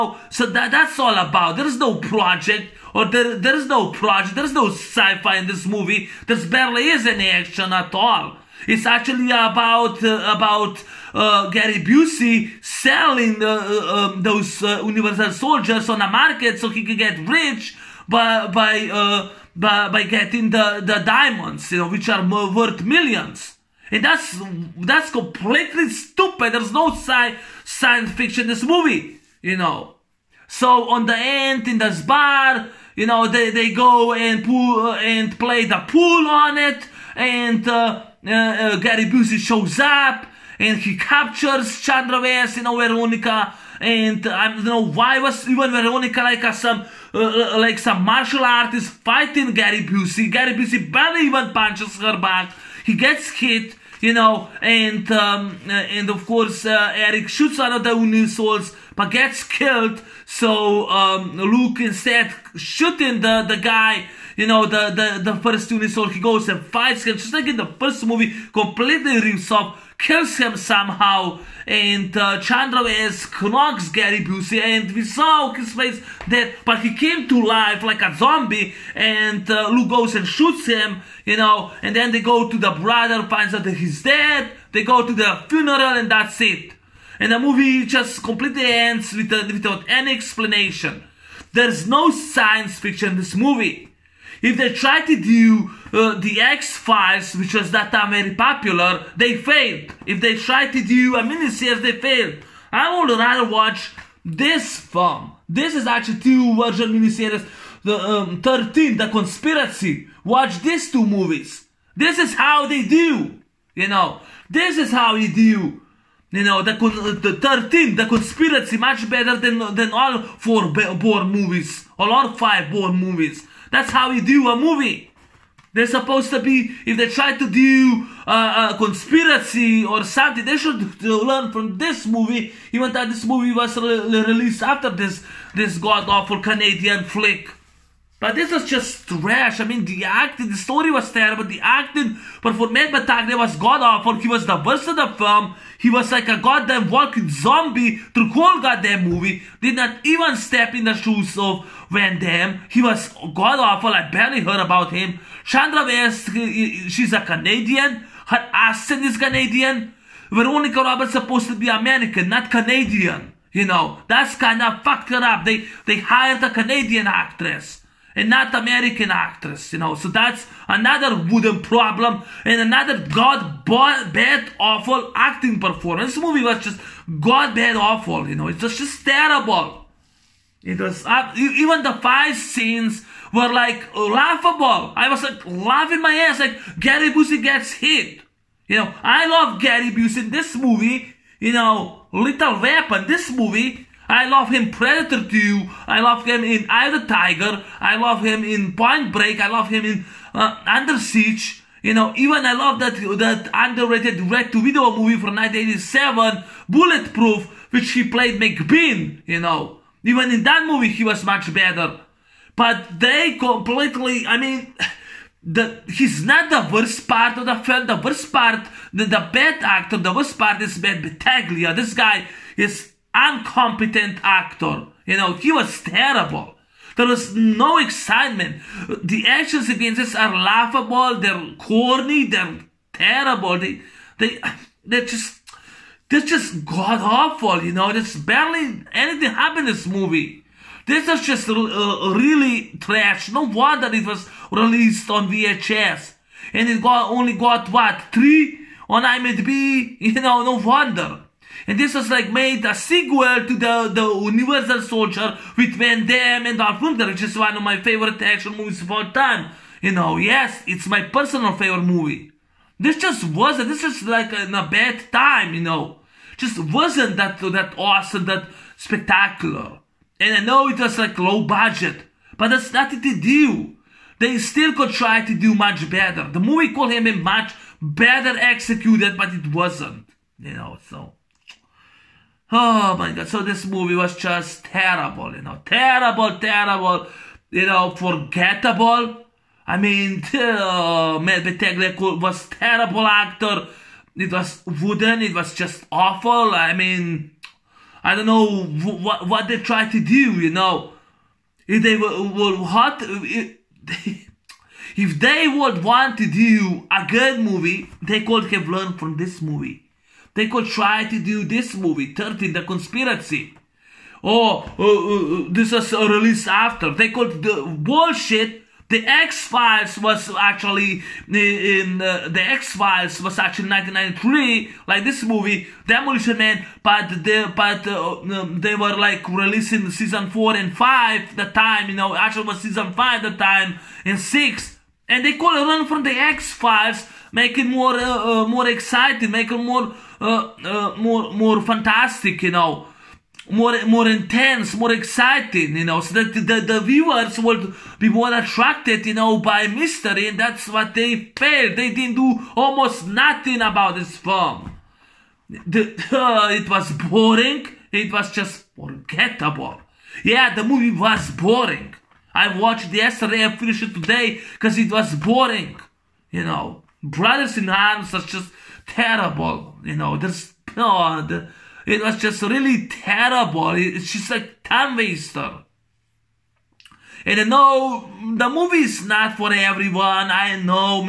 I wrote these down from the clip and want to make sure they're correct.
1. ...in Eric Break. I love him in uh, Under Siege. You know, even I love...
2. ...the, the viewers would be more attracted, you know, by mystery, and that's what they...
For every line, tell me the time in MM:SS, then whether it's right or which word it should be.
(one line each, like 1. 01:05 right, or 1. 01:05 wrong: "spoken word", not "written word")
1. 03:18 wrong: "Point", not "Eric"
2. 05:46 right.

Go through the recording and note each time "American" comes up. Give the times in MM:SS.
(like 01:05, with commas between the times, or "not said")
02:41, 02:48.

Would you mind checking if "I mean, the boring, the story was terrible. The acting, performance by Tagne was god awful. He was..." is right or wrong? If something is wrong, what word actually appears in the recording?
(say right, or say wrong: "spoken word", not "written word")
wrong: "acting", not "boring".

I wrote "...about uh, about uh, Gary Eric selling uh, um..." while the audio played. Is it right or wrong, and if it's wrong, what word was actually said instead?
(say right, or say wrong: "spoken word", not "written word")
wrong: "Busey", not "Eric".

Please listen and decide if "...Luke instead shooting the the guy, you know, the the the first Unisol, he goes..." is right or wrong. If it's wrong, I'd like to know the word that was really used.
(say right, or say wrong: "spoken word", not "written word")
right.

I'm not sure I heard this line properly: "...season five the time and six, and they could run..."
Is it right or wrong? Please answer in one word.
right.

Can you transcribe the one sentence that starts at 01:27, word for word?
And the movie just completely ends with, uh, without any explanation.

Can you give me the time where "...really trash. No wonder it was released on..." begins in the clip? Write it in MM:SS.
04:02.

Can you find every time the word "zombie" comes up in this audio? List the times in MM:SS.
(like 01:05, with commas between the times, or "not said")
01:18, 02:27.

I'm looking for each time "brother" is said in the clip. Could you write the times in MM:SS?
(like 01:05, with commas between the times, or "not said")
01:22, 06:07.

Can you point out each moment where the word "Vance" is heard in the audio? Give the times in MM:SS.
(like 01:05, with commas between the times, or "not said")
00:42.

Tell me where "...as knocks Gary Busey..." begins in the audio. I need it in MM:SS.
01:12.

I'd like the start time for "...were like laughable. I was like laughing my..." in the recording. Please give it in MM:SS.
03:03.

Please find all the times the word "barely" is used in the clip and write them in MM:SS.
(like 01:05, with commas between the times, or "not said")
00:06, 00:50, 02:34, 03:58.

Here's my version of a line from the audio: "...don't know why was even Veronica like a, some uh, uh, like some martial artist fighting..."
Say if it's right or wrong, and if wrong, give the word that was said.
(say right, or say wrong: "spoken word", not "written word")
right.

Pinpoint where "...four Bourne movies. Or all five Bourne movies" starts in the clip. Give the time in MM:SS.
02:00.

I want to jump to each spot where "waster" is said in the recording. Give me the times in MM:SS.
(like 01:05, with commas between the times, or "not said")
06:14.